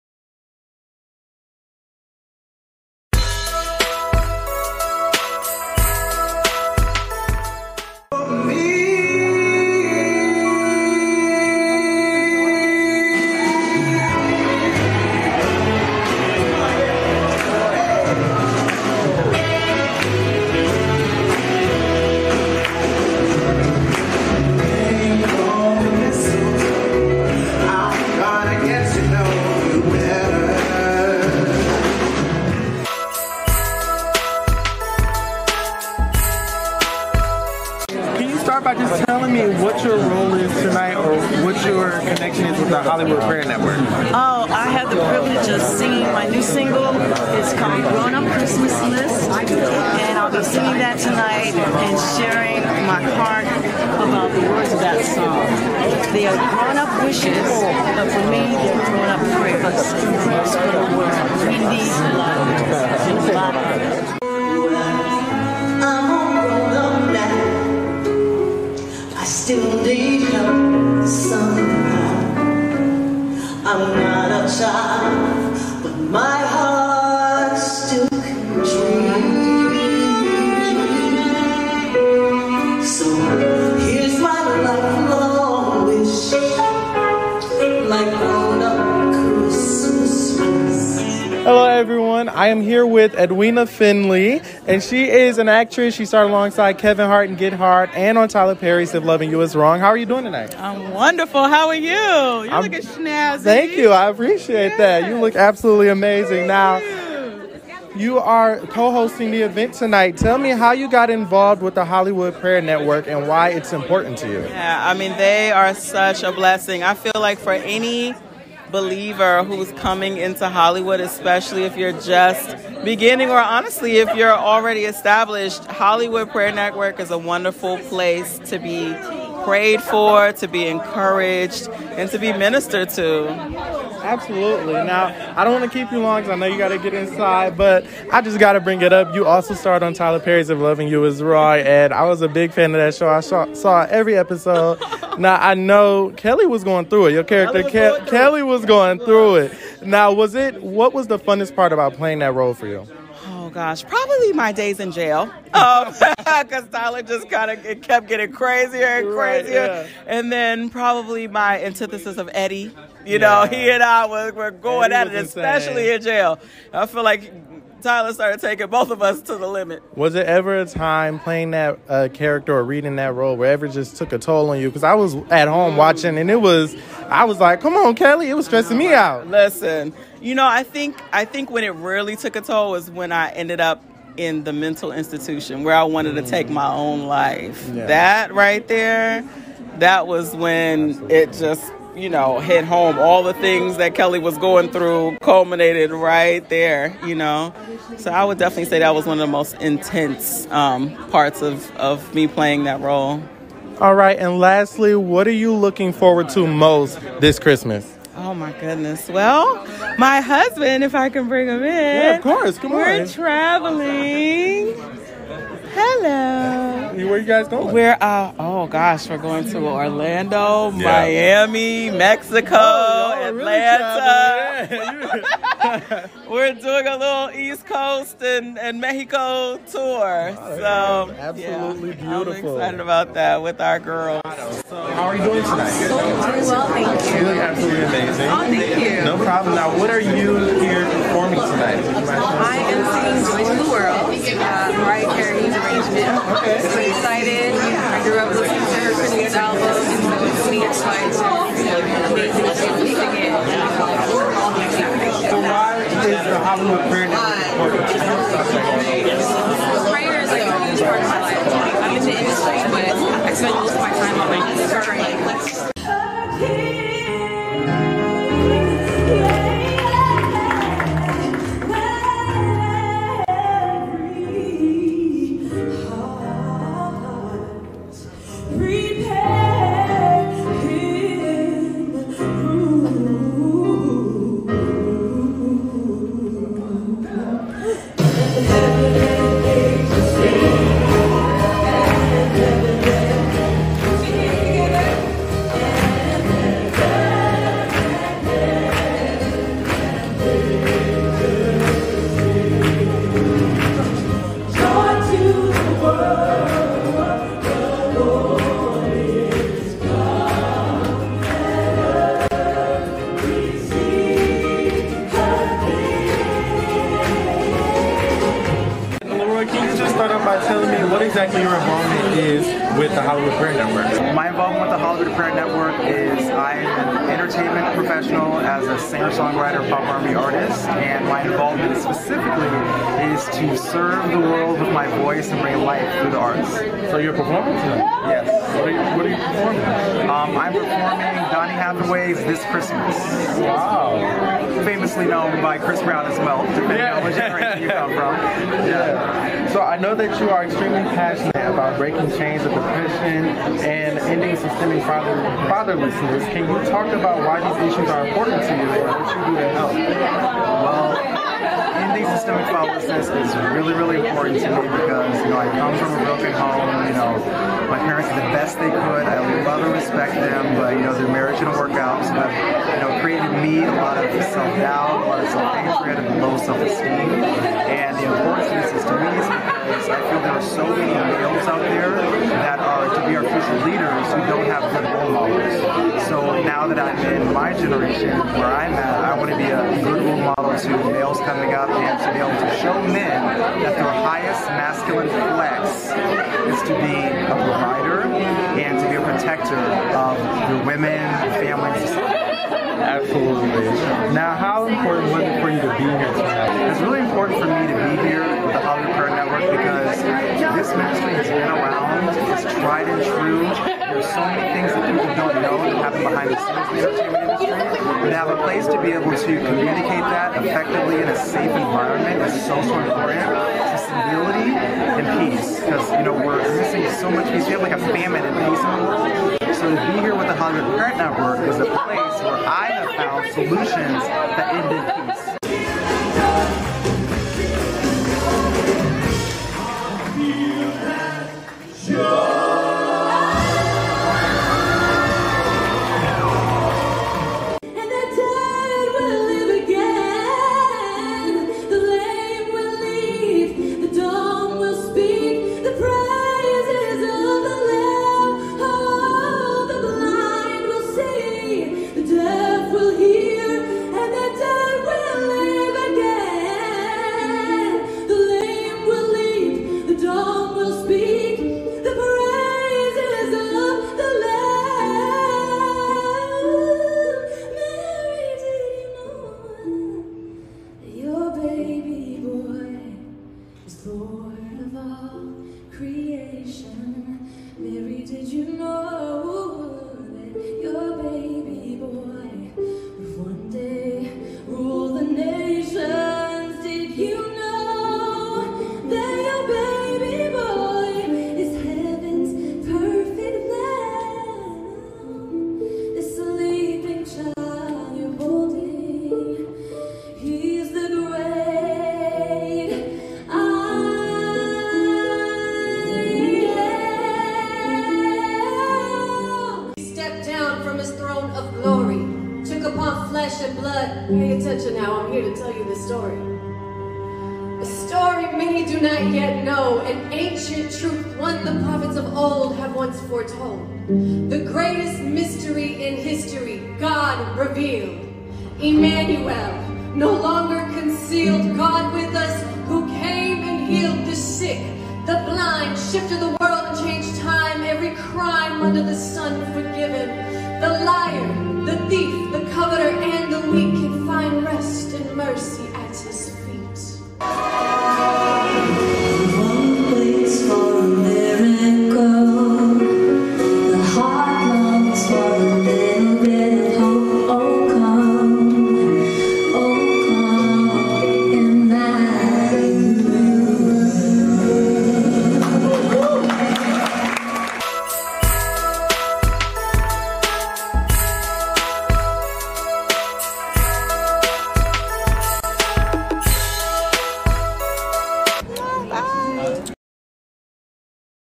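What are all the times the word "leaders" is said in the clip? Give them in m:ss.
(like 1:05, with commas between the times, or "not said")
6:23.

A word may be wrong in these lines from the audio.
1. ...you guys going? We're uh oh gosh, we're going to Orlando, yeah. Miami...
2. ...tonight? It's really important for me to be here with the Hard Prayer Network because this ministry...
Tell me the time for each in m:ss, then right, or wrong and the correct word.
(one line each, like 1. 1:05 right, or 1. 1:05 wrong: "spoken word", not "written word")
1. 3:37 right
2. 6:46 wrong: "Hollywood", not "Hard".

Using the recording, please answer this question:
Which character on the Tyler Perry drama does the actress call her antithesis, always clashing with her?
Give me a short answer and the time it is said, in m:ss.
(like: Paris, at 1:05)
Eddie, at 2:42.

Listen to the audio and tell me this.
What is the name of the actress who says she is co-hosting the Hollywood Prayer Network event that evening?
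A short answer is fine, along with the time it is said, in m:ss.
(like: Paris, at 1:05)
Edwina Findley, at 1:33.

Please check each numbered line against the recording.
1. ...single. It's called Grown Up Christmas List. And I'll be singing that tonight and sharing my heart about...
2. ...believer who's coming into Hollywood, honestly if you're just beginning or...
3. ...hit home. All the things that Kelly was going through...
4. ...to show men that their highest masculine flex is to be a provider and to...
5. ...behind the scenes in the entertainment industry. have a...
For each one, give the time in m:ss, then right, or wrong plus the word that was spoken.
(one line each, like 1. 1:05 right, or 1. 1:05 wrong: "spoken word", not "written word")
1. 0:46 right
2. 1:58 wrong: "especially", not "honestly"
3. 3:12 right
4. 6:32 right
5. 6:56 right.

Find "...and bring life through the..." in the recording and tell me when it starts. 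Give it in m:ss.
5:35.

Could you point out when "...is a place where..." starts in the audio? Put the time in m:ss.
7:11.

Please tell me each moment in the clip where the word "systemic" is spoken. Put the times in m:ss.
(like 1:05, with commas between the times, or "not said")
5:54, 6:02.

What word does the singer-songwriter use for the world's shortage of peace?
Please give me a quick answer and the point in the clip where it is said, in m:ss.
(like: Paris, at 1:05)
Famine, at 7:07.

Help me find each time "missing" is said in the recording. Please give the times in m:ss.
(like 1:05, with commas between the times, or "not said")
7:06.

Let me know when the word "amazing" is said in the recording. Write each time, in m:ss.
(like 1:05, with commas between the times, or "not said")
1:45, 3:57, 4:12.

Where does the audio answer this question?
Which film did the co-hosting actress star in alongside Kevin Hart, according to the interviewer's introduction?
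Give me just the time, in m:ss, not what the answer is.
1:37.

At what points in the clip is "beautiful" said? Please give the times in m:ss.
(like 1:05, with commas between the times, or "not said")
3:52.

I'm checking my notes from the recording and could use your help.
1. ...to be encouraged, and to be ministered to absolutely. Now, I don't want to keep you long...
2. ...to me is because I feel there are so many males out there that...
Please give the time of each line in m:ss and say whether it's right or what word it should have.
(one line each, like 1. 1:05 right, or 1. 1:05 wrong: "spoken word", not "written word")
1. 2:10 right
2. 6:18 right.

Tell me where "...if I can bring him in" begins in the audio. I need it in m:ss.
3:30.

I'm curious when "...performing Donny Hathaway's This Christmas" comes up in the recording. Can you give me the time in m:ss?
5:40.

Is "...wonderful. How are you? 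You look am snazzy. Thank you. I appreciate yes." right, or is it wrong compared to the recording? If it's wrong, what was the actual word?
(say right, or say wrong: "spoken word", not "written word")
right.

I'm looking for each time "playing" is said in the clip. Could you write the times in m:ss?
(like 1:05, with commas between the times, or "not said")
2:31, 2:51, 3:22.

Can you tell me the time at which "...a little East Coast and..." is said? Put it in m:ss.
3:46.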